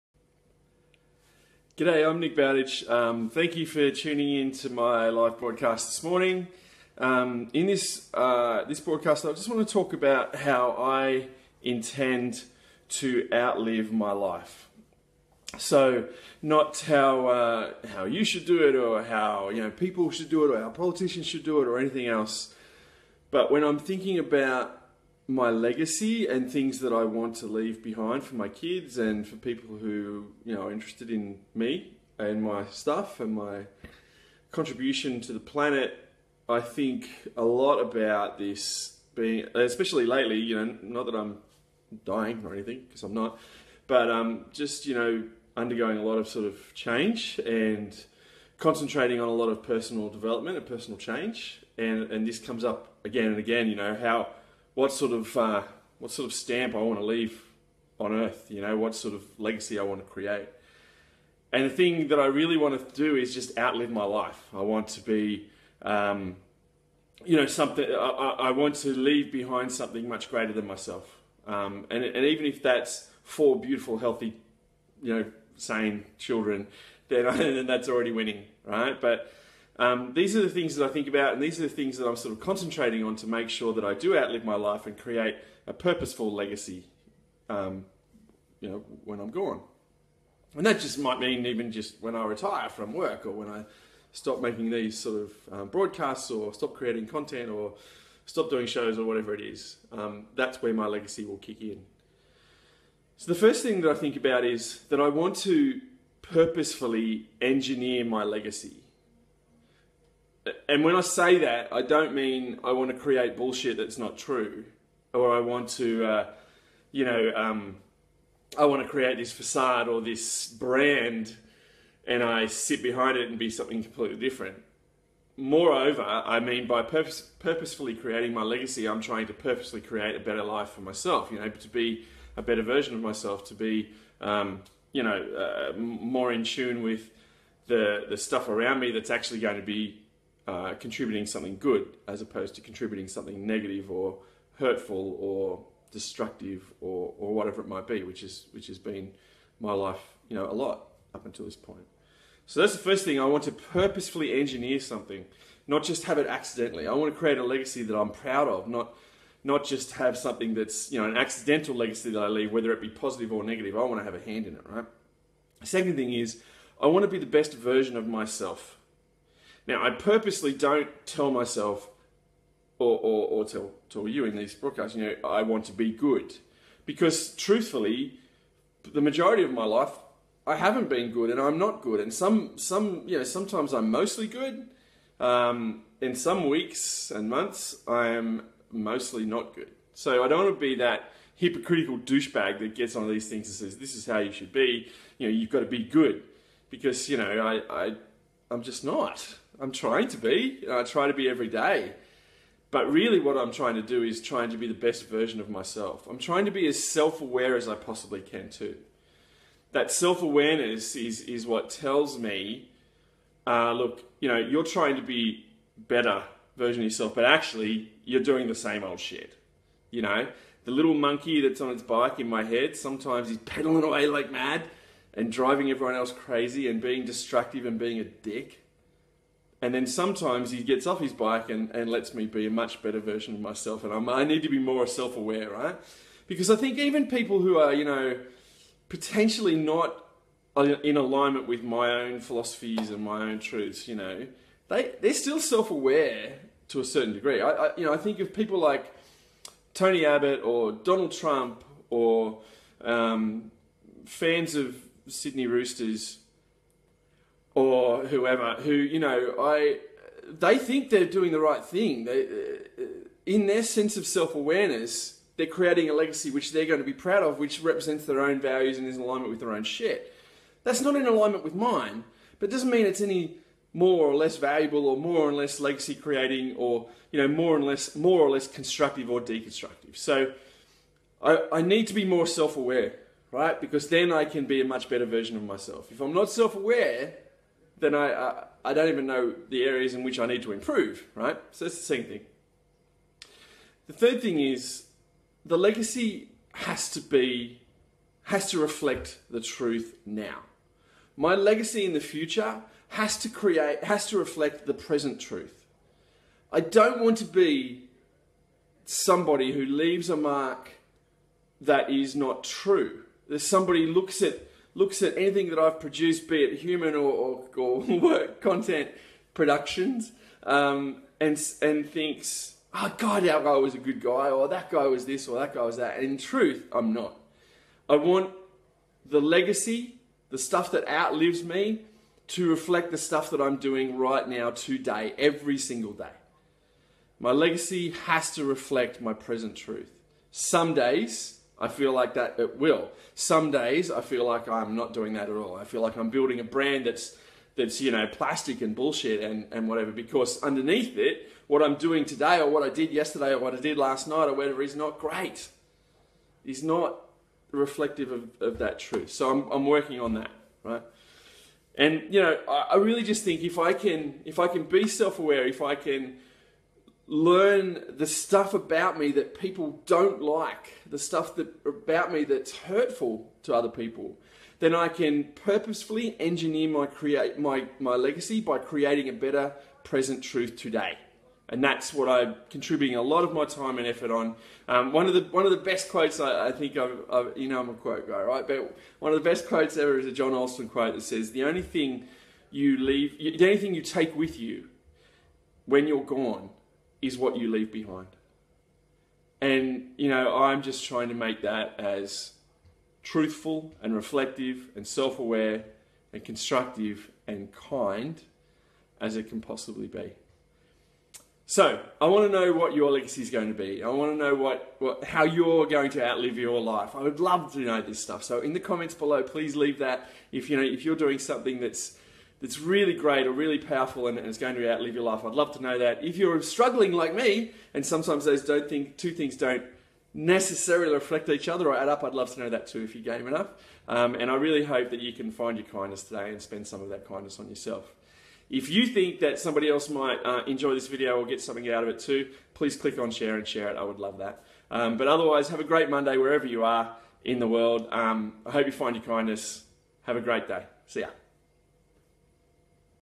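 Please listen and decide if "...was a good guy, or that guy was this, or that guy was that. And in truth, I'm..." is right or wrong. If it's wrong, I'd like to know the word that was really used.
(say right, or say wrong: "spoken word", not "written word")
right.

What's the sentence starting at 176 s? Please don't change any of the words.
Because truthfully, the majority of my life, I haven't been good and I'm not good.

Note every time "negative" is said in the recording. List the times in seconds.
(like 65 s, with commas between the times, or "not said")
143 s, 163 s.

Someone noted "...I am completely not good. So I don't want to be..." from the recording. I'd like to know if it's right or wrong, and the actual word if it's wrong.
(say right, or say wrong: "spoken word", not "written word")
wrong: "mostly", not "completely".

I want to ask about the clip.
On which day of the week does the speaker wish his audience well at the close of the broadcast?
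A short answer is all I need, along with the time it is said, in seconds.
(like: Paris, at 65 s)
Monday, at 445 s.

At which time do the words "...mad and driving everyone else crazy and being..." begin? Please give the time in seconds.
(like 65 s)
224 s.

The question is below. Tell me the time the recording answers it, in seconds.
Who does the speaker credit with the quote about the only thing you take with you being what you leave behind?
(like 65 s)
390 s.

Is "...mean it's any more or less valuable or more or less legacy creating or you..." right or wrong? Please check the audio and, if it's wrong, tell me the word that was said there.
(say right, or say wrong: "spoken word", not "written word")
right.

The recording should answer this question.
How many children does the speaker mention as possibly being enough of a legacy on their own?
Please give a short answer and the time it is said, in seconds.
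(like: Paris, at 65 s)
4, at 73 s.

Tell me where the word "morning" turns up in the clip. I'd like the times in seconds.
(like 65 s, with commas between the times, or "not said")
6 s.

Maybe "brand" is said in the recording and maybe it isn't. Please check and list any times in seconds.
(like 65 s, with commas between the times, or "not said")
120 s, 346 s.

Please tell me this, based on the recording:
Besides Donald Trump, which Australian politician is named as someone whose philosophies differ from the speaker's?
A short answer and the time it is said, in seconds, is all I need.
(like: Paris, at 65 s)
Tony Abbott, at 249 s.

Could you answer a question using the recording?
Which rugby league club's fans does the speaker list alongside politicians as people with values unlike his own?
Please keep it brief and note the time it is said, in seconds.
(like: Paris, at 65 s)
Sydney Roosters, at 255 s.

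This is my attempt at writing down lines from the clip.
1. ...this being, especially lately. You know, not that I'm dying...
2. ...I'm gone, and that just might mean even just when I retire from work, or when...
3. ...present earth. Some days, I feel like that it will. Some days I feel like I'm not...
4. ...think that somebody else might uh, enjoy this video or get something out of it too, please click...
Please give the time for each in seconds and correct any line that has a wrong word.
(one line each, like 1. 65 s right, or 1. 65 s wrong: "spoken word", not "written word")
1. 38 s right
2. 89 s right
3. 339 s wrong: "truth", not "earth"
4. 438 s right.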